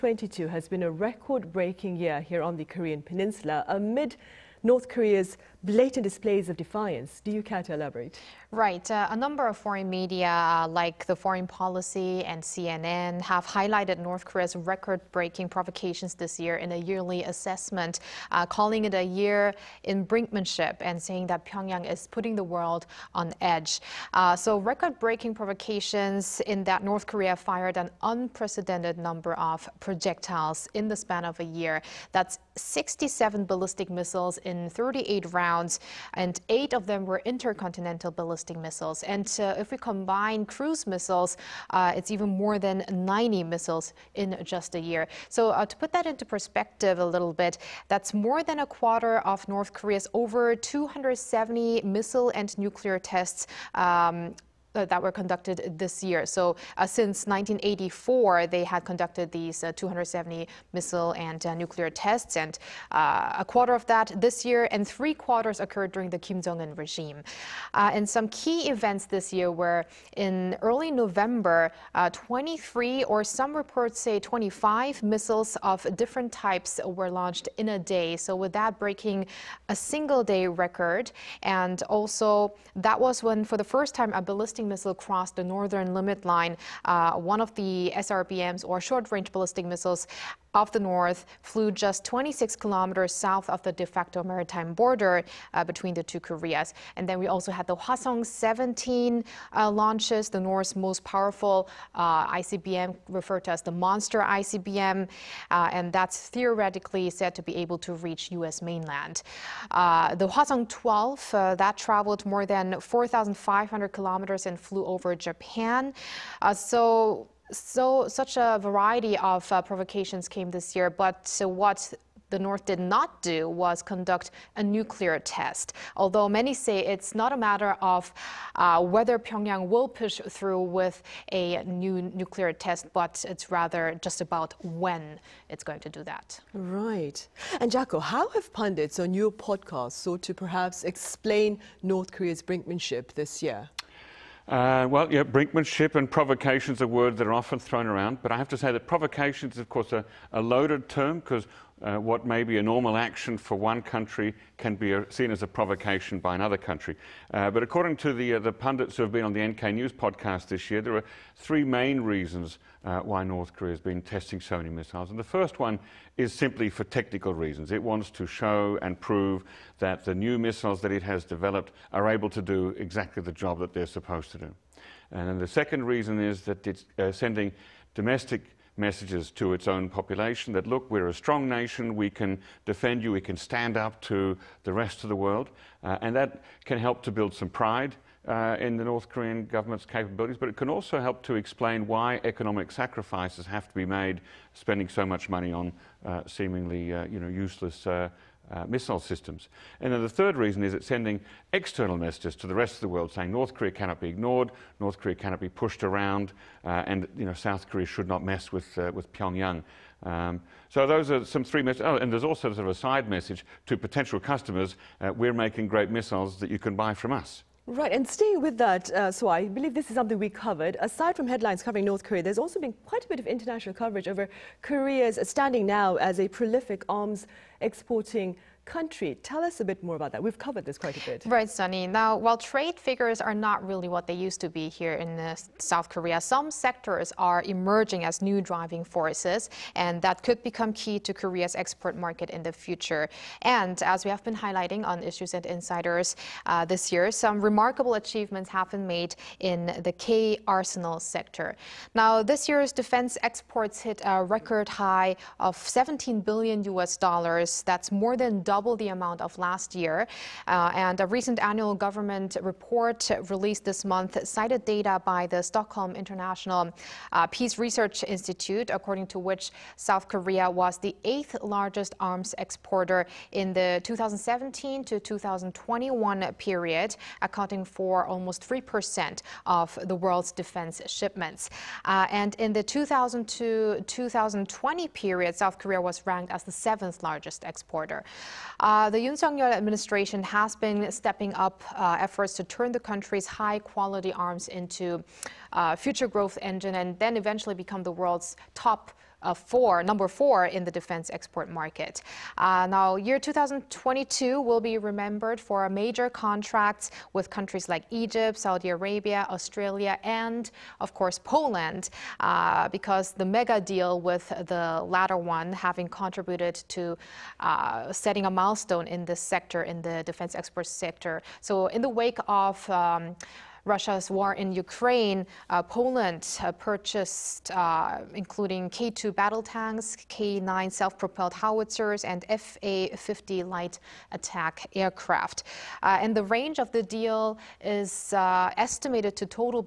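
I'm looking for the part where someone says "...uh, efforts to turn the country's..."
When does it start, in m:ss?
4:51.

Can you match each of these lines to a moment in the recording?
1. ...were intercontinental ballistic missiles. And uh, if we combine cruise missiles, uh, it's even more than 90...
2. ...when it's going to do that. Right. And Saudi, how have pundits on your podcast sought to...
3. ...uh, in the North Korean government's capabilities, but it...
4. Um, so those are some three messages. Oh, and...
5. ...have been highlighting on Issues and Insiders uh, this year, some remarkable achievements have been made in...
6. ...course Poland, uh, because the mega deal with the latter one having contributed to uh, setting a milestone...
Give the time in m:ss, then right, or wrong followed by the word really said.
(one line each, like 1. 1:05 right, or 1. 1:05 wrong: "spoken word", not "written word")
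1. 0:37 right
2. 2:14 wrong: "Jacco", not "Saudi"
3. 3:08 right
4. 3:30 right
5. 4:04 right
6. 5:10 right.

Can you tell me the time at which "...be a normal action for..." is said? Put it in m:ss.
2:32.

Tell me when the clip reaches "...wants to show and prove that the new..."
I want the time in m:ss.
2:47.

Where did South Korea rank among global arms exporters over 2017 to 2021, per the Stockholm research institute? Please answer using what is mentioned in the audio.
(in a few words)
eighth.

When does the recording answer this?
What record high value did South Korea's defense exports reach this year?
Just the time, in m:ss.
4:15.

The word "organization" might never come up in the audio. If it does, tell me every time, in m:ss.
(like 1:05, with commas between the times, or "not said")
not said.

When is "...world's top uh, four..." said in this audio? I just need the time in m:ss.
4:57.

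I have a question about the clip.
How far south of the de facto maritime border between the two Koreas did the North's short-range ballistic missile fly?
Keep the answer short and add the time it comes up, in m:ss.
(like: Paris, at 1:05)
26 kilometers, at 1:32.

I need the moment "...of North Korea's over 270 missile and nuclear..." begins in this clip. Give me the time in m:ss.
0:49.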